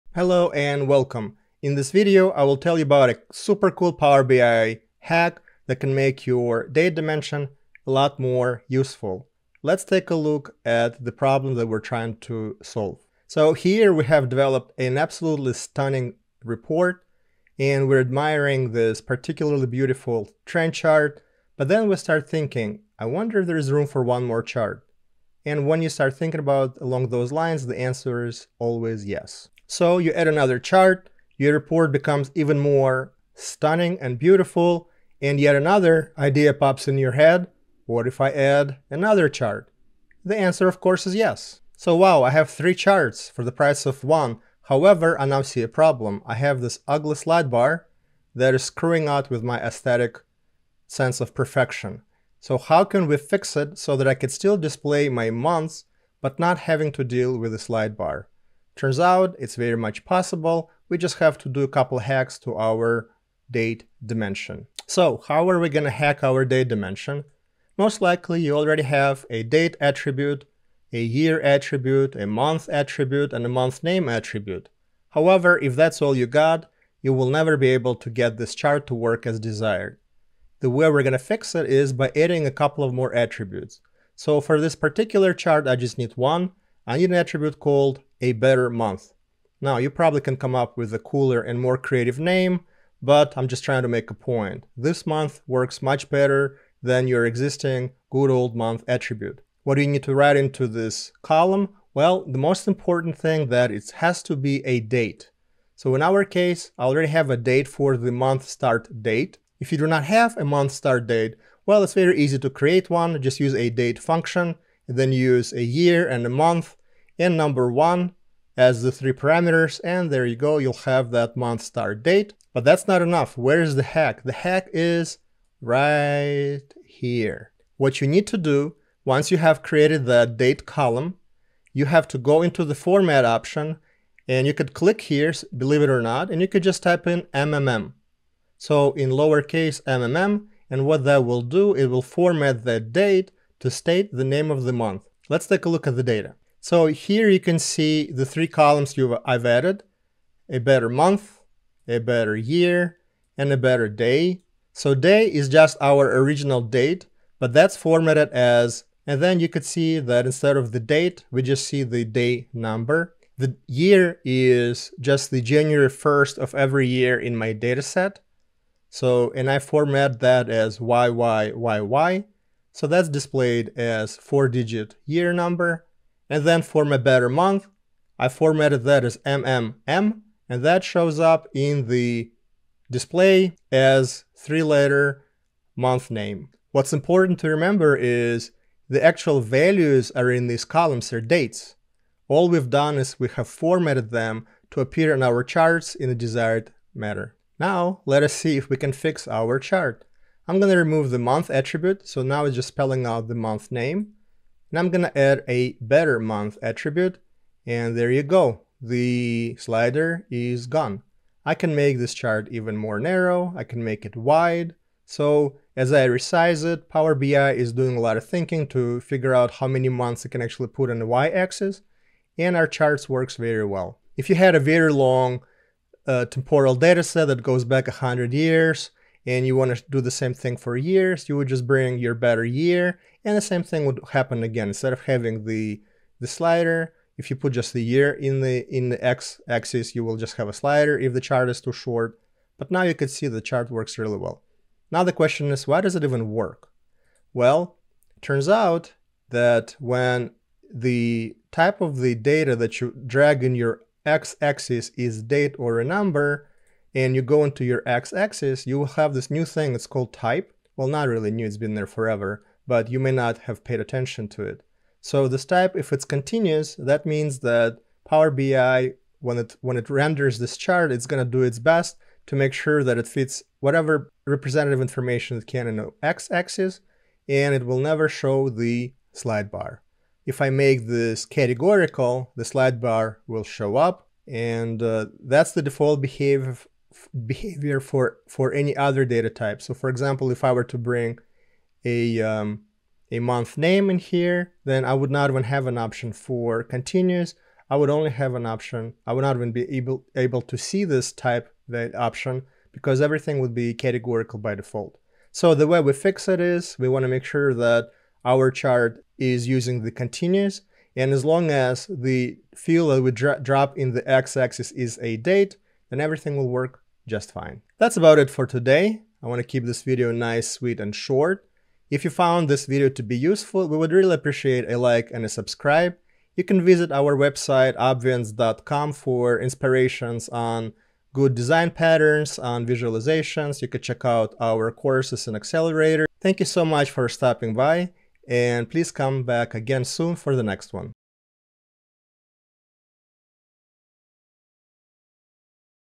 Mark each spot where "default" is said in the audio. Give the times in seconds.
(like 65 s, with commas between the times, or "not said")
285 s, 304 s.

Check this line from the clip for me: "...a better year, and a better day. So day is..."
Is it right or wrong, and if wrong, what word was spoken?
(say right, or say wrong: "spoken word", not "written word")
right.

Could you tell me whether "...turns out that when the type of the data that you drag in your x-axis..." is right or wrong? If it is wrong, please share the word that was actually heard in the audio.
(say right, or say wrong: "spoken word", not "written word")
right.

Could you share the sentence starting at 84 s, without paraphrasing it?
So for this particular chart, I just need one.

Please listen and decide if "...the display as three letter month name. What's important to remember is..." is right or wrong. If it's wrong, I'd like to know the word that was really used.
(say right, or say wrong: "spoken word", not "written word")
right.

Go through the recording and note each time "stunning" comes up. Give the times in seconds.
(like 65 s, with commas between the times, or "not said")
15 s, 33 s.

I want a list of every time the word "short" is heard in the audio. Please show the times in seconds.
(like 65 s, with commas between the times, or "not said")
241 s, 320 s.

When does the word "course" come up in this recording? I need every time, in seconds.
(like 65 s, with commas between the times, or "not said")
40 s, 334 s.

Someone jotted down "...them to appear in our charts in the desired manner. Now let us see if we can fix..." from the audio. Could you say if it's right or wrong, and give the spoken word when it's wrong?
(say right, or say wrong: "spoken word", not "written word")
right.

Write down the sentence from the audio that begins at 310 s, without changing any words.
And as long as the field that we dro drop in the x-axis is a date, then everything will work just fine.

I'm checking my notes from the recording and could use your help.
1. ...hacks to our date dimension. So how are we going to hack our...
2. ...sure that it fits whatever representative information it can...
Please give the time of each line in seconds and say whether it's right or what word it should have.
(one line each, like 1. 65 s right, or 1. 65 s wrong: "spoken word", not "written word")
1. 61 s right
2. 272 s right.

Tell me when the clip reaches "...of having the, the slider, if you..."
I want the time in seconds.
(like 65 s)
234 s.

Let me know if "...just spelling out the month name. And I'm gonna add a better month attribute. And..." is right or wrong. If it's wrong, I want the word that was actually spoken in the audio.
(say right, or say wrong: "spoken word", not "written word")
right.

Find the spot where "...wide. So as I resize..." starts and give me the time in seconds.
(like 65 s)
214 s.